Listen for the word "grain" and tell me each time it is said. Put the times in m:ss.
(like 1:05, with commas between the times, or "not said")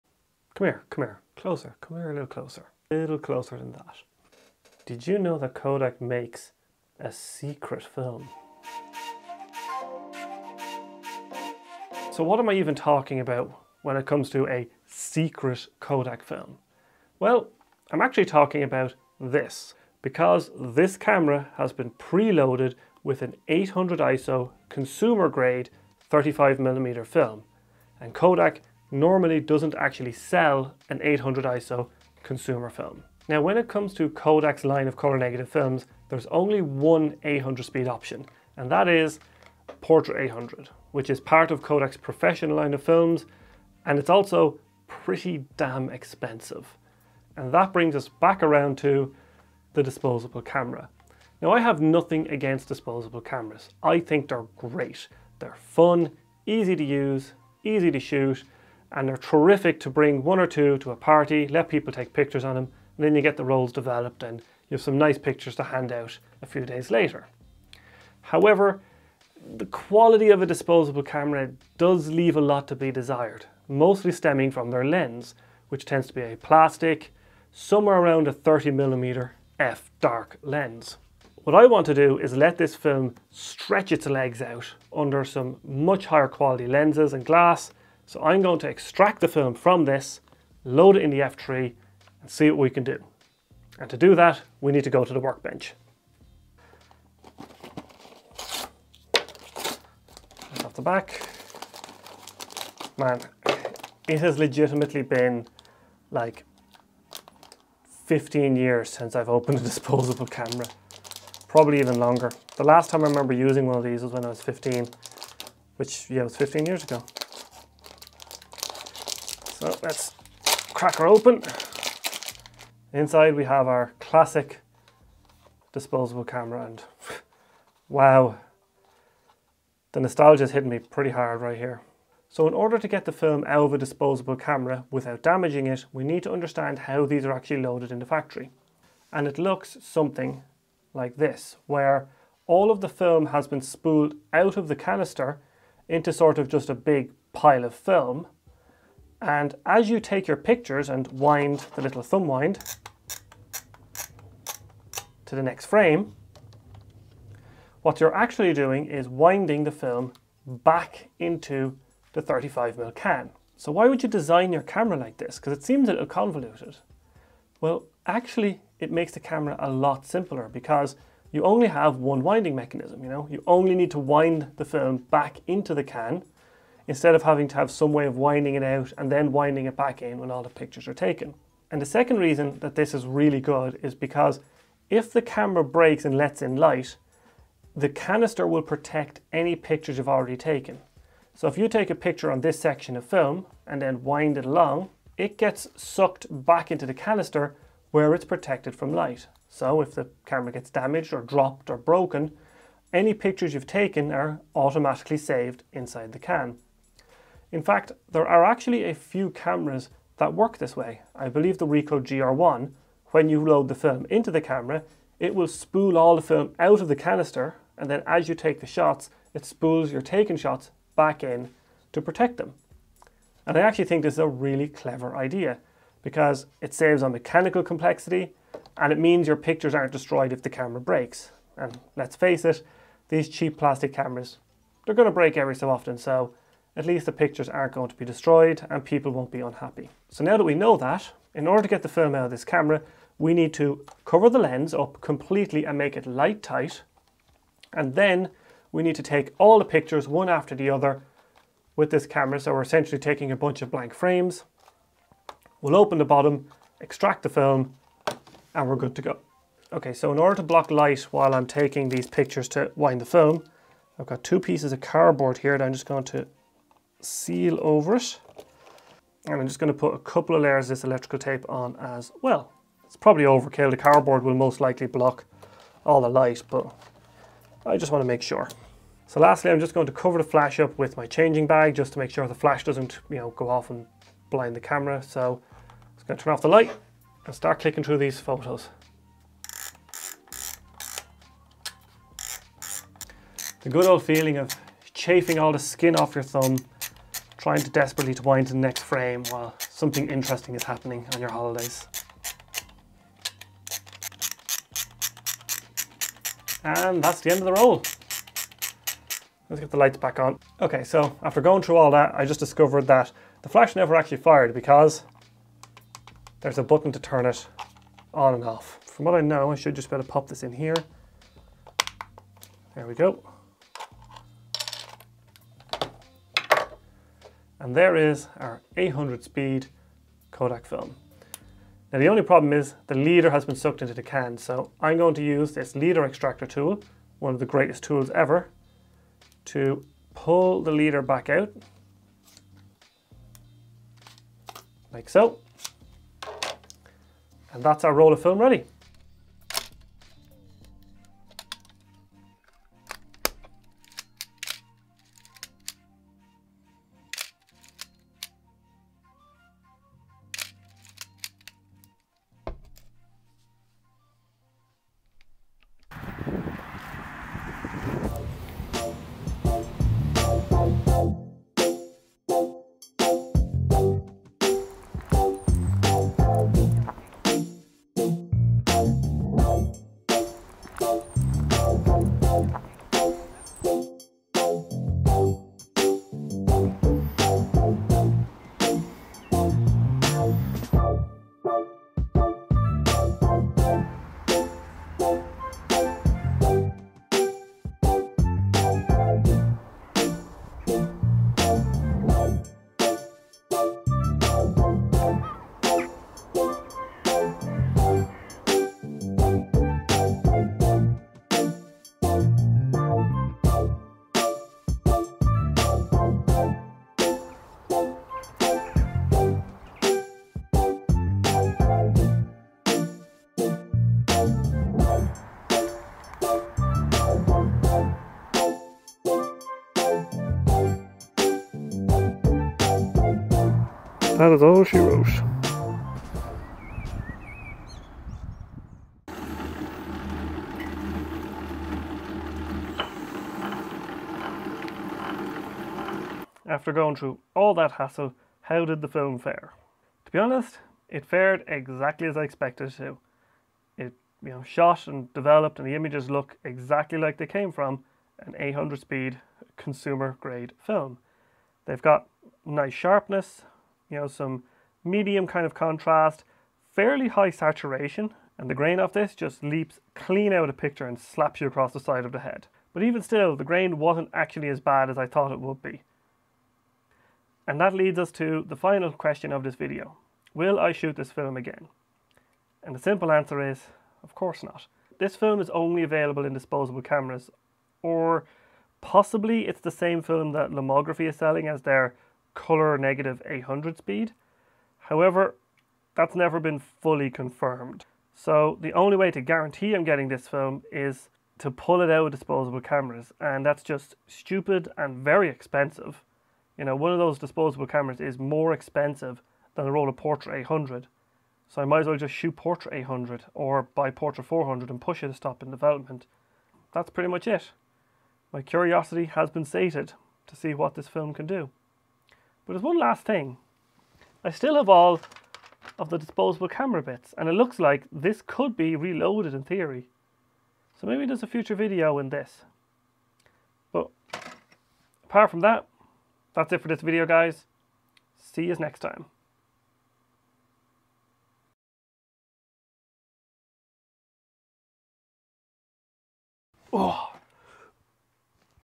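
7:48, 7:53.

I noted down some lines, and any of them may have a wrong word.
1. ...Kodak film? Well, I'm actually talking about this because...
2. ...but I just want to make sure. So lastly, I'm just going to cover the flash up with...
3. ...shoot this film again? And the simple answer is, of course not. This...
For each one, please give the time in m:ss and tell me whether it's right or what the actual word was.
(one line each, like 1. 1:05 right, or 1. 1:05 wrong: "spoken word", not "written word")
1. 0:15 right
2. 4:36 right
3. 8:00 right.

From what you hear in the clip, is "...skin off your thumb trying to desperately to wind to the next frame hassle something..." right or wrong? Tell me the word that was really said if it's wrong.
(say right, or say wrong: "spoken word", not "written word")
wrong: "while", not "hassle".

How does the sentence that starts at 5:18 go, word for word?
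From what I know, I should just better pop this in here.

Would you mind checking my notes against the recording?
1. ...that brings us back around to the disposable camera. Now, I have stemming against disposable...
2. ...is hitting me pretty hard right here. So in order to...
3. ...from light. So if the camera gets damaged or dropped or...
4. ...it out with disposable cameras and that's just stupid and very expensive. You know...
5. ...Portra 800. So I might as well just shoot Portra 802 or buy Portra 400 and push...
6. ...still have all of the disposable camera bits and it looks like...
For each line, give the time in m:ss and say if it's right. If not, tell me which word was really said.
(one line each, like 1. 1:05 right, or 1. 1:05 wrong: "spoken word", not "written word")
1. 0:47 wrong: "nothing", not "stemming"
2. 2:10 right
3. 3:18 right
4. 8:21 right
5. 8:29 wrong: "800", not "802"
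6. 8:44 right.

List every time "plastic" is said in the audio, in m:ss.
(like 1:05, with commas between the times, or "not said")
1:16, 3:53.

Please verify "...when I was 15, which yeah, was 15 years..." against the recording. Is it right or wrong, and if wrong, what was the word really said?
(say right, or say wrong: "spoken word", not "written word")
right.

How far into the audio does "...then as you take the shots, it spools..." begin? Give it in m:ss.
3:37.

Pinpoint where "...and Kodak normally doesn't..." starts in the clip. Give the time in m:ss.
0:28.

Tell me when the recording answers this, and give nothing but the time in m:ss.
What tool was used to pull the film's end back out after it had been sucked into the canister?
5:35.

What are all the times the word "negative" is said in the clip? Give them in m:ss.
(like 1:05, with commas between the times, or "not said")
0:35, 8:12.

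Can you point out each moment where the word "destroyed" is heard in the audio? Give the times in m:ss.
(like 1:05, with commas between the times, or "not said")
3:49, 3:58.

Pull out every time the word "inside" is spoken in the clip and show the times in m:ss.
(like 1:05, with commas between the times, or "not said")
2:02, 3:25.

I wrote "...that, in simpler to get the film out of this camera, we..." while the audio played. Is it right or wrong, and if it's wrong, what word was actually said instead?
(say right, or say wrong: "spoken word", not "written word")
wrong: "order", not "simpler".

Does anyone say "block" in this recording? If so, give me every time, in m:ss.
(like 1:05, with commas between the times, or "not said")
4:20, 4:34.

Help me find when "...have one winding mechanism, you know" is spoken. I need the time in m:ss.
2:51.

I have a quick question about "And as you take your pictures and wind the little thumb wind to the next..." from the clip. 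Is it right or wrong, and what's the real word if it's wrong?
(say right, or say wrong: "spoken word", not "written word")
right.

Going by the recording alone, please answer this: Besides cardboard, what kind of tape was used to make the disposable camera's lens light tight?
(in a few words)
electrical tape.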